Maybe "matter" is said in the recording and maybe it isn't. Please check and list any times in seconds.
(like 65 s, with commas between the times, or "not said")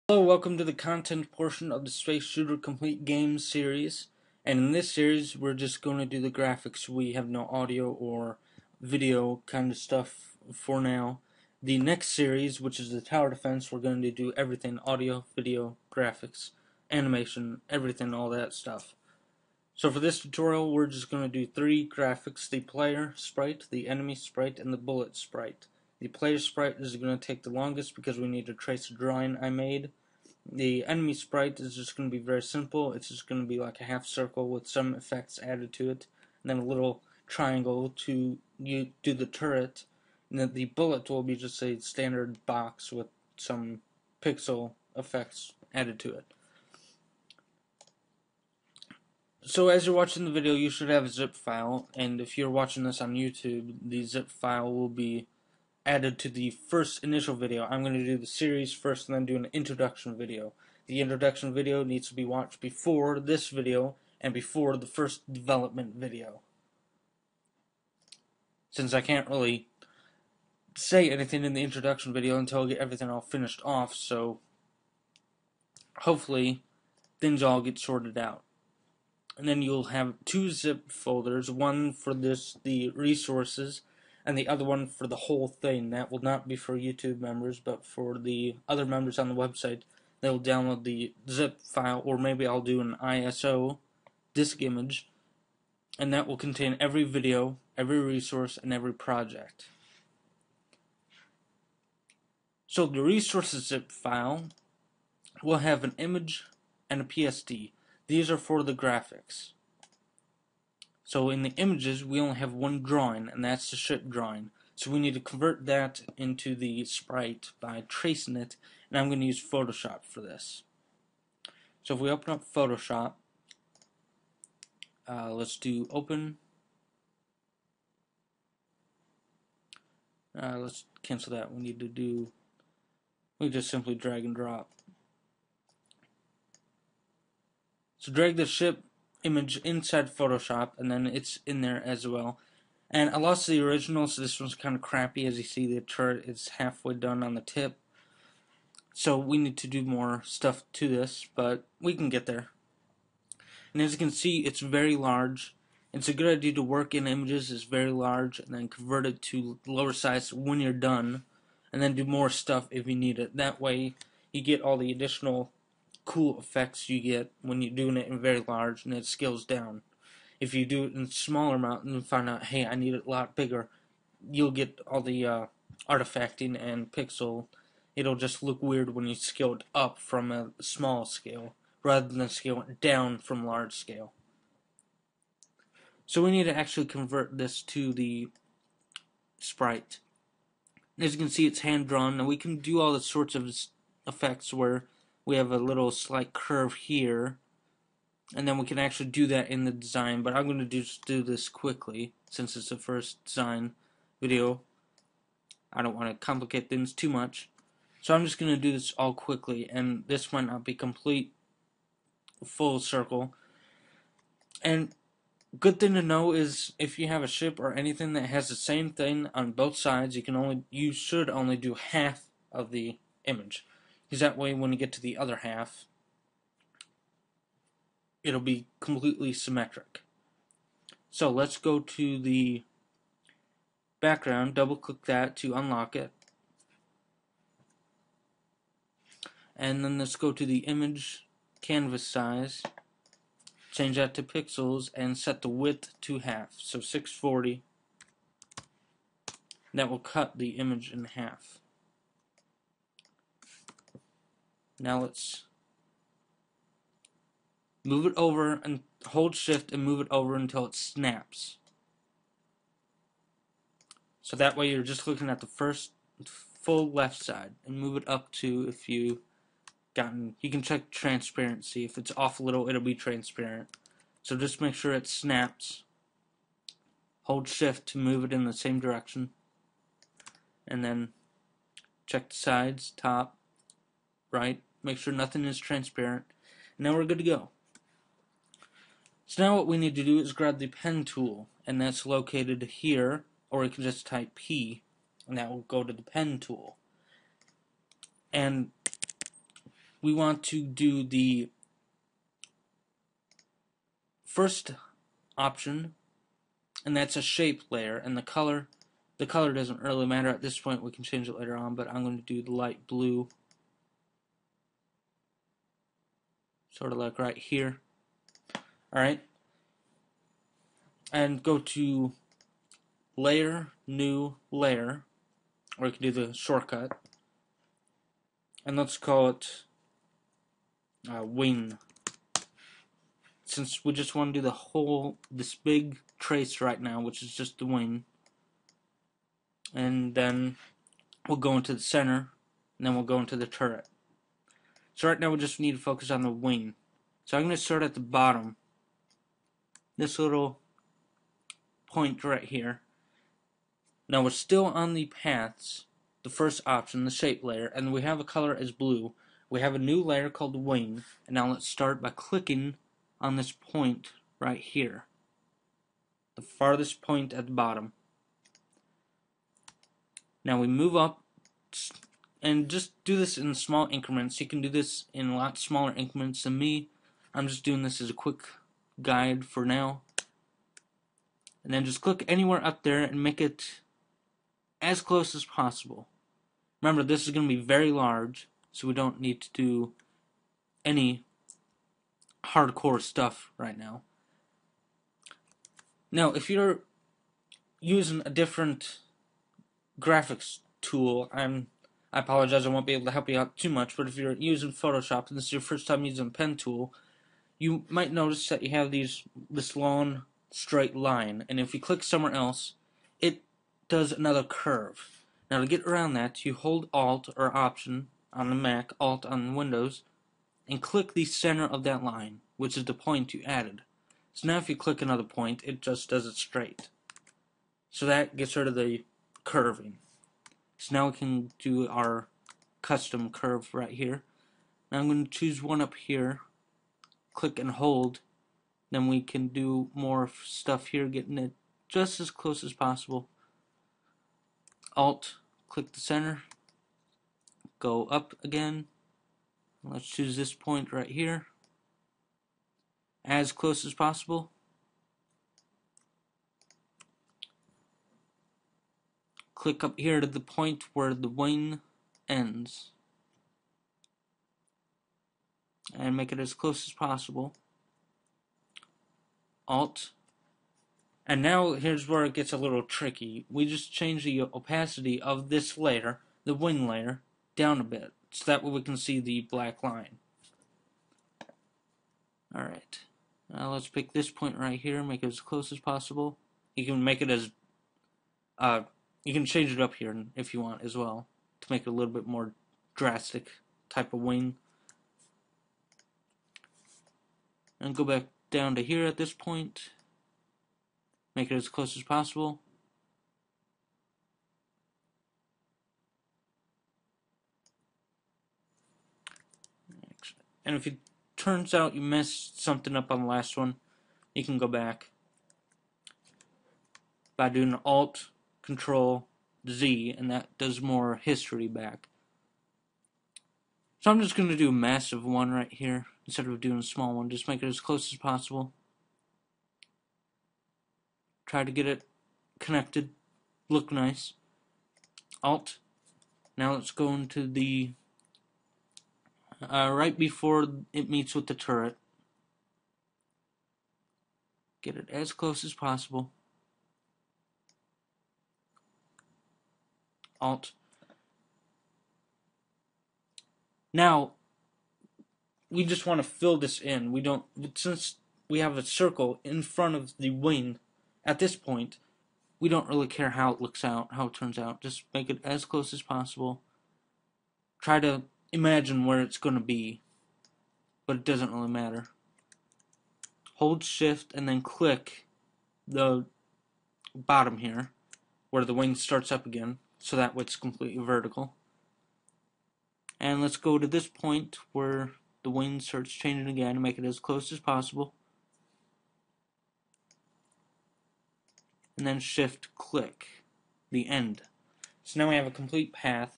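310 s, 571 s.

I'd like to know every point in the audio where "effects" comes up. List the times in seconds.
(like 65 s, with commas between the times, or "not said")
34 s, 44 s, 166 s, 194 s.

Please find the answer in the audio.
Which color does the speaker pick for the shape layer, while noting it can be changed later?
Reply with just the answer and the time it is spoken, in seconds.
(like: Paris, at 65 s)
Light blue, at 312 s.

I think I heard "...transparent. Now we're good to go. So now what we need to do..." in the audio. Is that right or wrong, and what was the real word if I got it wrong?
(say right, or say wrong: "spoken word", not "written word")
right.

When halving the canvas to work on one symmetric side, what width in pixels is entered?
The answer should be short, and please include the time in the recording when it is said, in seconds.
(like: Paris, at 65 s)
640, at 246 s.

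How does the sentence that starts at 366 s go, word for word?
The farthest point at the bottom.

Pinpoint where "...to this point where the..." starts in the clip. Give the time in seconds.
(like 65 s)
583 s.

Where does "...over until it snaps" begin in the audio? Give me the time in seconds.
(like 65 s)
260 s.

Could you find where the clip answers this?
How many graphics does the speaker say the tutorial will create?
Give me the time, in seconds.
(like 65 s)
21 s.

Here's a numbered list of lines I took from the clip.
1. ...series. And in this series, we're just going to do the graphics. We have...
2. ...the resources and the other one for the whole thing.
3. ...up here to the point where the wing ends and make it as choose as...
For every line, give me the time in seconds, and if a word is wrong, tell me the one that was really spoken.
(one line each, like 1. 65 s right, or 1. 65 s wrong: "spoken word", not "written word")
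1. 3 s right
2. 82 s right
3. 459 s wrong: "close", not "choose".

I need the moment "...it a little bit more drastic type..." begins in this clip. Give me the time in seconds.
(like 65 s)
491 s.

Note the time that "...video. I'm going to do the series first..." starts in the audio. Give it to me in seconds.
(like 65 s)
57 s.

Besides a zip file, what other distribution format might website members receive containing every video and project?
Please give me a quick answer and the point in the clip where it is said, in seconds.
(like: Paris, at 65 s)
ISO disk image, at 93 s.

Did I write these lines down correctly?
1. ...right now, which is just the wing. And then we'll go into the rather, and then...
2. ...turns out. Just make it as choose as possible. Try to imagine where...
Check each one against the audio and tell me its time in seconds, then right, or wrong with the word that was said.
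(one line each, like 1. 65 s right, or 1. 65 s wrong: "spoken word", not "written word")
1. 336 s wrong: "center", not "rather"
2. 564 s wrong: "close", not "choose".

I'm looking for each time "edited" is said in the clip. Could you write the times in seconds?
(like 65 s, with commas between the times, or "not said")
not said.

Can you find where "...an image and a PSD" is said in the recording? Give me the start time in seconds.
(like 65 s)
105 s.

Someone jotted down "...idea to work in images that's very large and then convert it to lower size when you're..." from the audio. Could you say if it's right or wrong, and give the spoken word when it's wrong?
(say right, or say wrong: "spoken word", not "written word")
right.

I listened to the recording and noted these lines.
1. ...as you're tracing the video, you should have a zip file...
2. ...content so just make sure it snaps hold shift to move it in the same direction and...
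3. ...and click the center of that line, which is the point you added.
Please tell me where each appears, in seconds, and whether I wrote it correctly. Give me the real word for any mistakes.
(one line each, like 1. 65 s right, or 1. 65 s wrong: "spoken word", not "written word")
1. 49 s wrong: "watching", not "tracing"
2. 272 s wrong: "transparent", not "content"
3. 420 s right.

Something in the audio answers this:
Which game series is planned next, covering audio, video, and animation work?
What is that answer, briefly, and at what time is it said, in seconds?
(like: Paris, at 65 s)
Tower defense, at 12 s.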